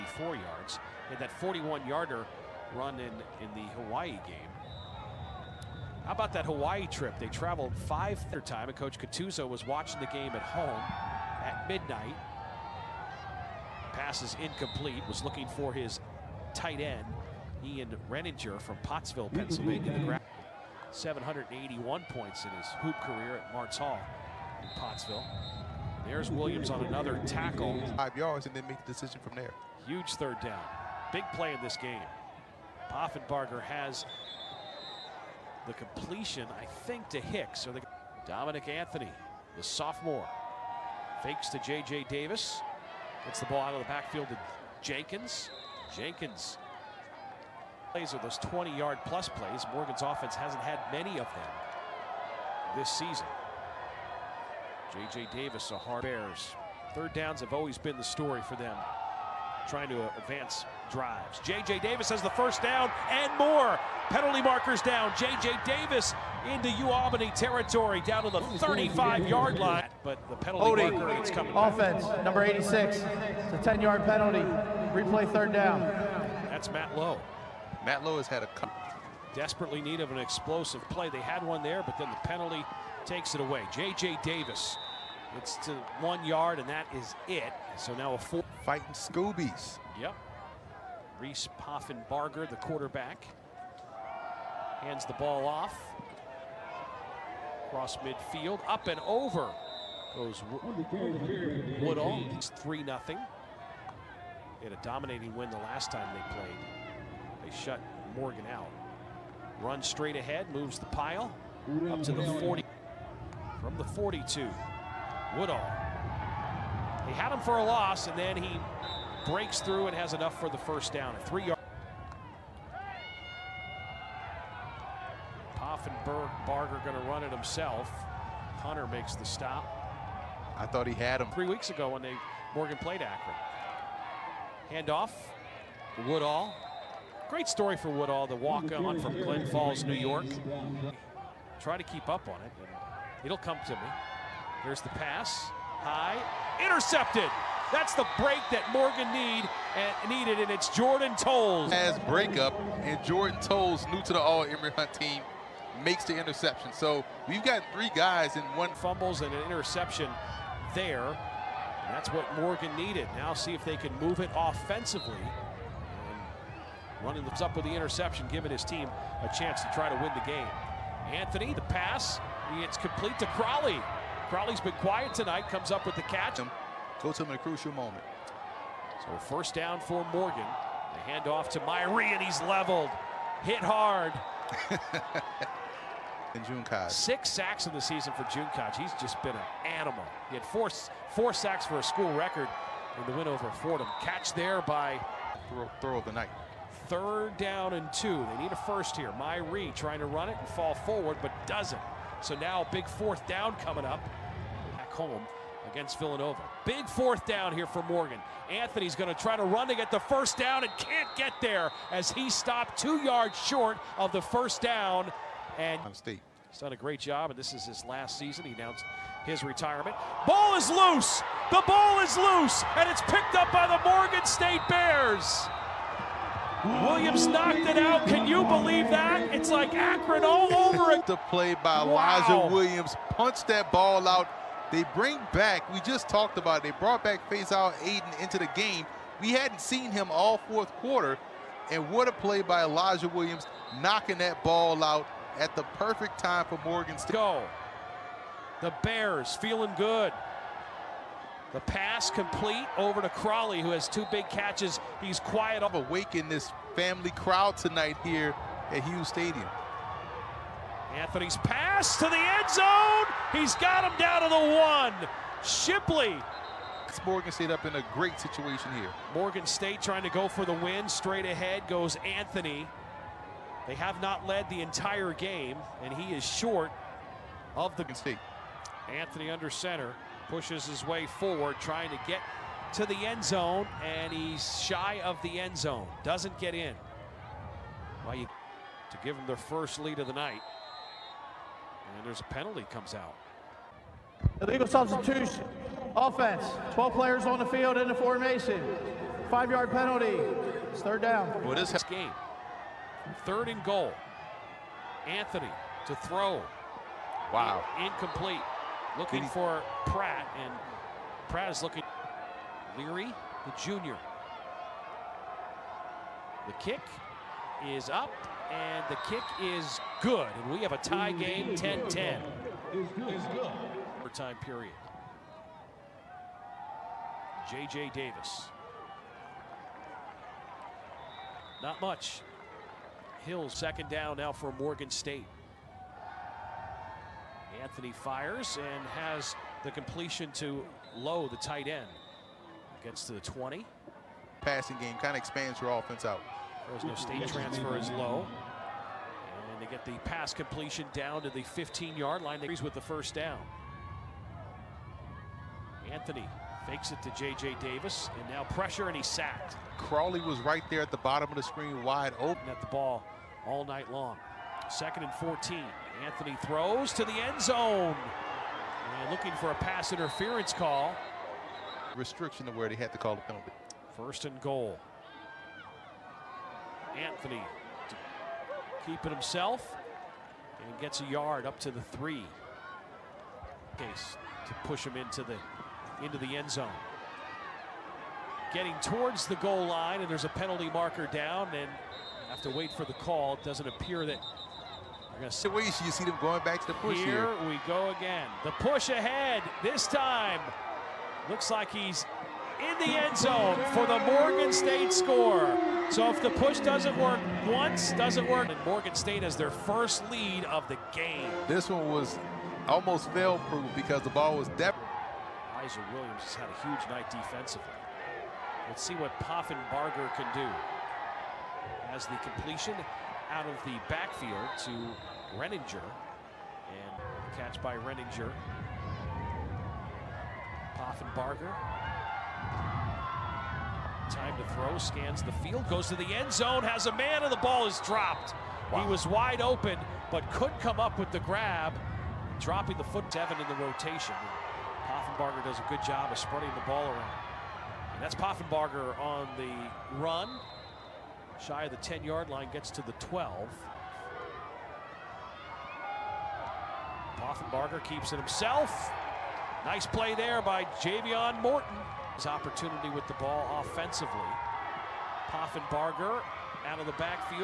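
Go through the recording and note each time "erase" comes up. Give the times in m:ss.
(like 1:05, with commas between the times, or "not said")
not said.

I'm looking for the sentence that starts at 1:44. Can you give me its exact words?
They had a dominating win the last time they played.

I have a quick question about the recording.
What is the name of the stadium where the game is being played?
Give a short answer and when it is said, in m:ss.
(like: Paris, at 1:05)
Hughes Stadium, at 4:18.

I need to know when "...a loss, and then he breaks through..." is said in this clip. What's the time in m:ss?
1:57.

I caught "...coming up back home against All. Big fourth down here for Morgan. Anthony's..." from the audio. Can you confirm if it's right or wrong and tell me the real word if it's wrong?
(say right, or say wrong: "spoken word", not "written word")
wrong: "Villanova", not "All".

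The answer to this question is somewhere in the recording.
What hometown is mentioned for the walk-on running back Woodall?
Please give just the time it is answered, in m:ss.
2:19.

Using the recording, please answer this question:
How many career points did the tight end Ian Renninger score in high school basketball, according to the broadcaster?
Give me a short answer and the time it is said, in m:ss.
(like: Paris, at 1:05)
781, at 0:20.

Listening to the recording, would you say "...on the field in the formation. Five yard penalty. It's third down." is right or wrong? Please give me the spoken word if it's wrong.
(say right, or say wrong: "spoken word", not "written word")
right.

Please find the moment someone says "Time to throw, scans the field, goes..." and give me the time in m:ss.
7:14.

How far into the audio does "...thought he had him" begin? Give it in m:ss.
2:10.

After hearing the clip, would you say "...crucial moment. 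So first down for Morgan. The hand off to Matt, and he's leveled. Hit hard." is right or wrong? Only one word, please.
wrong.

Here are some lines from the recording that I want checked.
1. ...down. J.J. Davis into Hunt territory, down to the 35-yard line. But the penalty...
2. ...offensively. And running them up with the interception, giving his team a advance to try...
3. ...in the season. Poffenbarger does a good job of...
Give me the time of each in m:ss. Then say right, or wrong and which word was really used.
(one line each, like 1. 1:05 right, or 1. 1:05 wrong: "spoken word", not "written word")
1. 1:04 wrong: "UAlbany", not "Hunt"
2. 2:44 wrong: "chance", not "advance"
3. 7:23 wrong: "rotation", not "season".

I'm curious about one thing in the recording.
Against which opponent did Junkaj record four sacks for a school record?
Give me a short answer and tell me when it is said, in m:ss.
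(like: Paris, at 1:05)
Fordham, at 3:13.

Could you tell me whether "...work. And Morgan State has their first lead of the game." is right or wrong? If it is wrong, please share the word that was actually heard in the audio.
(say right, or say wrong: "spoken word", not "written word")
right.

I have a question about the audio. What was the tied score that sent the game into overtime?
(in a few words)
10-10.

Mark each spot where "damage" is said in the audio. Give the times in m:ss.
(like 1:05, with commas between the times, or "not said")
not said.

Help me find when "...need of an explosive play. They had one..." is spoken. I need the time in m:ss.
1:19.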